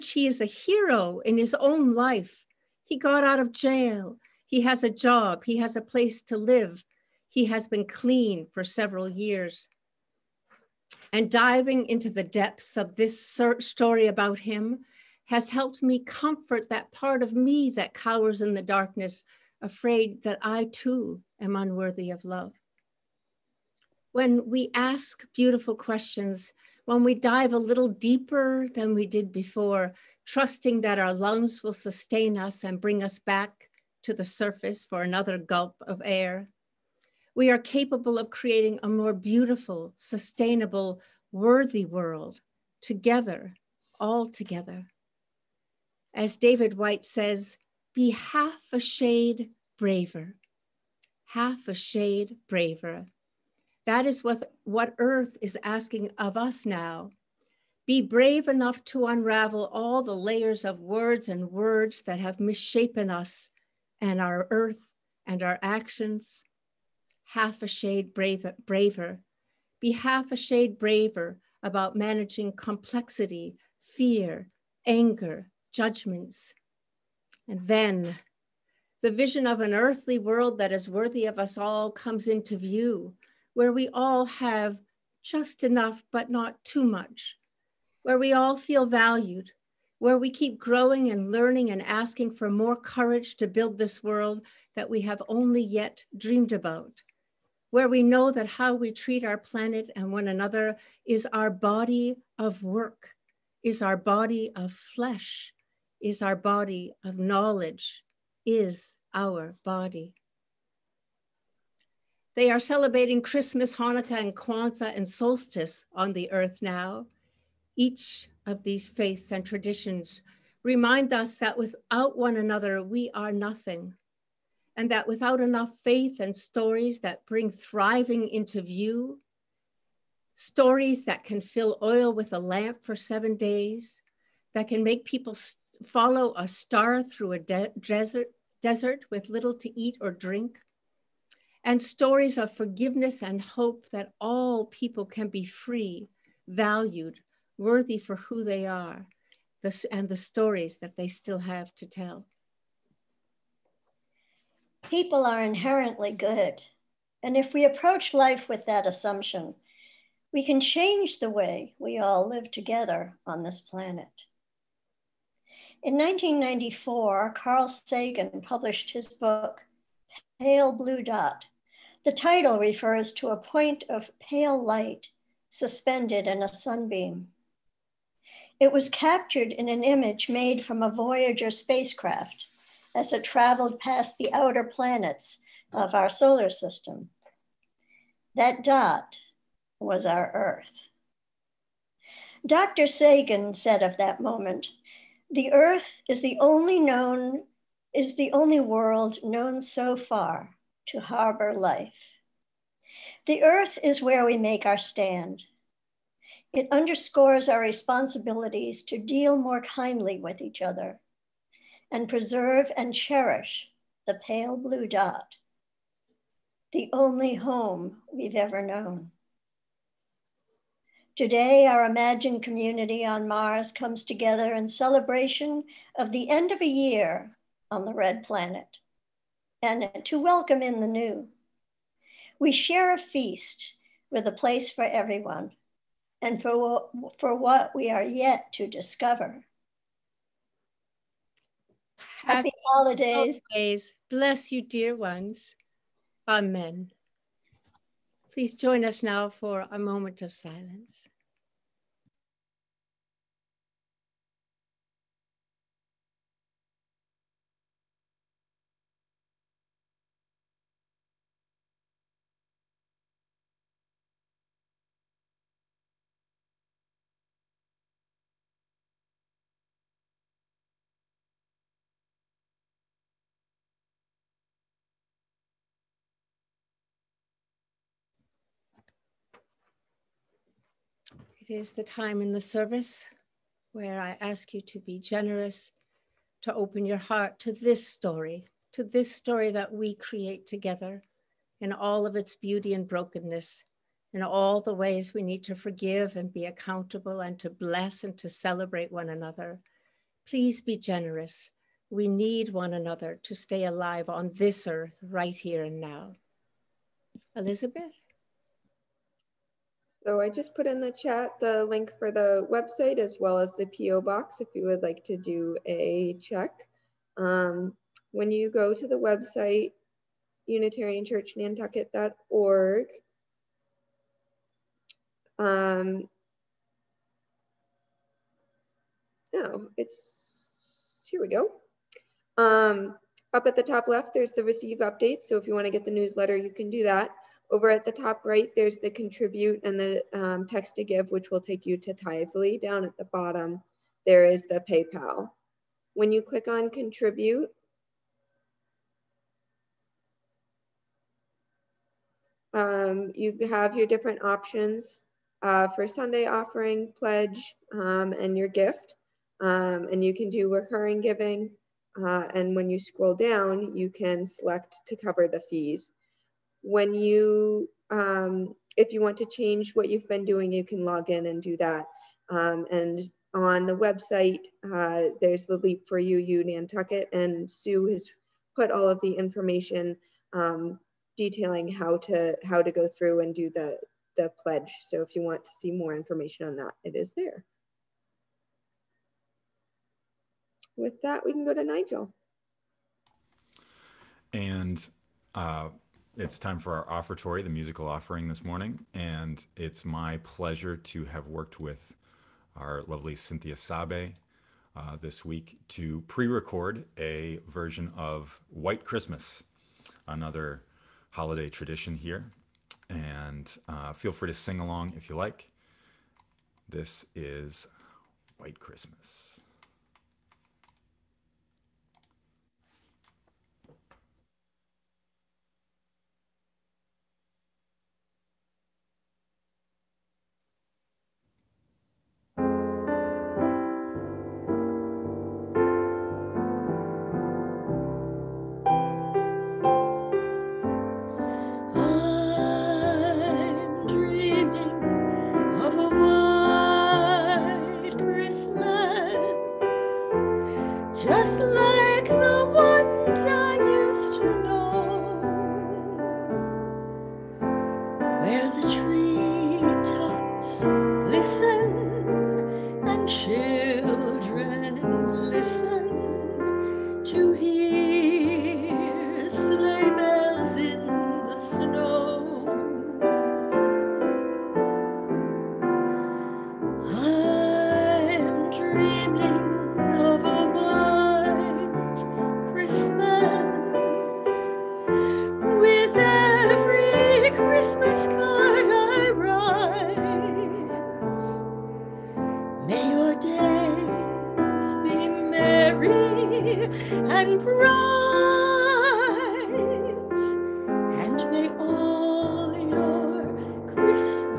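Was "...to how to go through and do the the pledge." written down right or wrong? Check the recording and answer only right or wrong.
right.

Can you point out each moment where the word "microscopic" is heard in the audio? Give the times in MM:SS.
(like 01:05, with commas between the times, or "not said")
not said.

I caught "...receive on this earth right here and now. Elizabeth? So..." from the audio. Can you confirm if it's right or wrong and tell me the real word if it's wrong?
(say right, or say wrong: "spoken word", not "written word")
wrong: "alive", not "receive".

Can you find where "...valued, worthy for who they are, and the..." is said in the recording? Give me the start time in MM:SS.
02:26.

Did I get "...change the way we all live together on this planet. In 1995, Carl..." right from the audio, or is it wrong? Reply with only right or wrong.
wrong.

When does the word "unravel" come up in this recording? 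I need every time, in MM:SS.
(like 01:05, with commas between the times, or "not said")
00:59.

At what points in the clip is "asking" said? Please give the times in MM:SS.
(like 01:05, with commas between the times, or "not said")
00:55, 01:31.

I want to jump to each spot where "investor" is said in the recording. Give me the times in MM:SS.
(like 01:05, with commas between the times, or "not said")
not said.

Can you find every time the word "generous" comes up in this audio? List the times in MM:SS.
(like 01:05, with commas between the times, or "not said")
04:44, 05:00.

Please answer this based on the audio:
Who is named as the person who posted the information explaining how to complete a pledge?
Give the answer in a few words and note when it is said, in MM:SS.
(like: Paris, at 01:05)
Sue, at 06:17.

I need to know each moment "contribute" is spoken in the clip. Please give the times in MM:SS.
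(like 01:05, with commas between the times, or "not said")
05:38, 05:46.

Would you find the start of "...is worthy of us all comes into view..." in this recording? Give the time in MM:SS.
01:20.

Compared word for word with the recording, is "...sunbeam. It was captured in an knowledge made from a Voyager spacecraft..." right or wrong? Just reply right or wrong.
wrong.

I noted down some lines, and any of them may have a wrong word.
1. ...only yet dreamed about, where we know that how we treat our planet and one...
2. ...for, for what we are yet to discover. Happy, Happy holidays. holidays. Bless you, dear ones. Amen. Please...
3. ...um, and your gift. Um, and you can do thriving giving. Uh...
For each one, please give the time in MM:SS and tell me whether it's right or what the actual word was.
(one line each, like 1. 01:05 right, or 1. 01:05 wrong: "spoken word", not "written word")
1. 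01:35 right
2. 03:56 right
3. 05:57 wrong: "recurring", not "thriving".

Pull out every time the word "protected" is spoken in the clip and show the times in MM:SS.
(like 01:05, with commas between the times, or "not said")
not said.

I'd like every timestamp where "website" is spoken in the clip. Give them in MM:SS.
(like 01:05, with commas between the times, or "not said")
05:12, 05:18, 06:13.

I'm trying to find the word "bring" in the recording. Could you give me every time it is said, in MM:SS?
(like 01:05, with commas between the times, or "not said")
00:32, 02:07.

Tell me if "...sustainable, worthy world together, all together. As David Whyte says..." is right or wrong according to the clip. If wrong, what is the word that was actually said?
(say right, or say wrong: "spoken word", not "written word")
right.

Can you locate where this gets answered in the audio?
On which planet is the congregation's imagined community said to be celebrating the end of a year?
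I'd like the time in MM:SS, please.
03:43.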